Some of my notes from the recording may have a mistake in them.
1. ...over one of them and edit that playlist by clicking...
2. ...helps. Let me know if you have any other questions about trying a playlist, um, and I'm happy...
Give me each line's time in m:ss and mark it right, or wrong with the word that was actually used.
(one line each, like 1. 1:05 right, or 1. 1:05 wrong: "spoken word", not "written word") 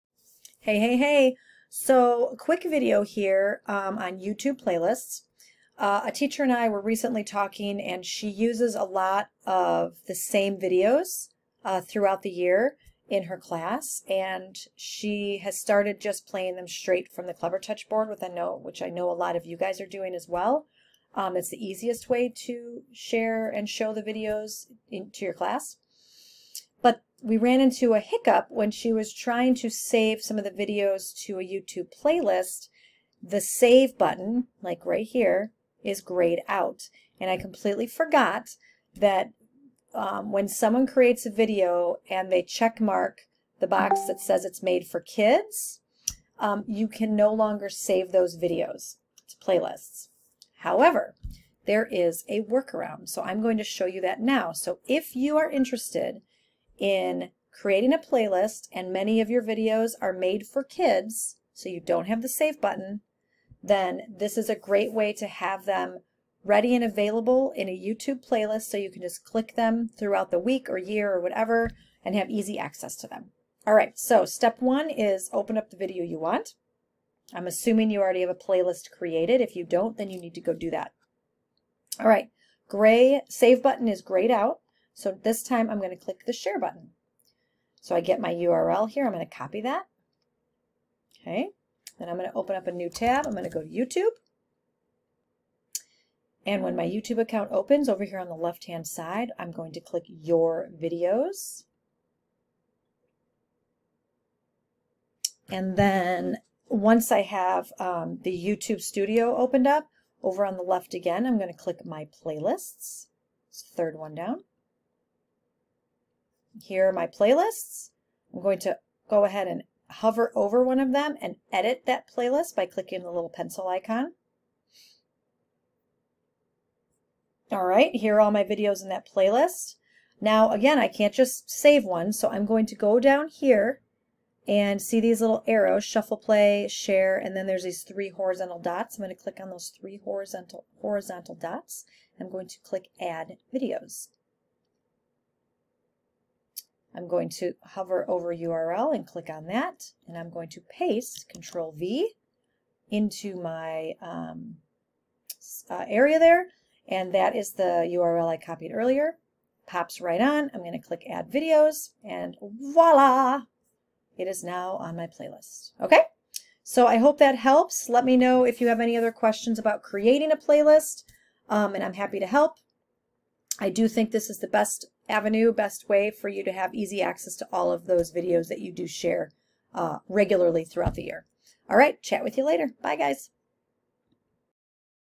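1. 2:00 right
2. 2:47 wrong: "creating", not "trying".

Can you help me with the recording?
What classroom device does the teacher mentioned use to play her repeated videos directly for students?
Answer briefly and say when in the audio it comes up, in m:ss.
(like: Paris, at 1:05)
Clevertouch board, at 0:17.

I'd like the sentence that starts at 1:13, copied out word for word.
All right, so step one is open up the video you want.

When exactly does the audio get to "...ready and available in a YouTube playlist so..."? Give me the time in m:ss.
1:06.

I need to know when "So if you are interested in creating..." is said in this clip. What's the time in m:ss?
0:54.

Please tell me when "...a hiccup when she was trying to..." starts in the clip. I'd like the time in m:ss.
0:27.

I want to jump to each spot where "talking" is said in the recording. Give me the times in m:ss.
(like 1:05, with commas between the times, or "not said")
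0:07.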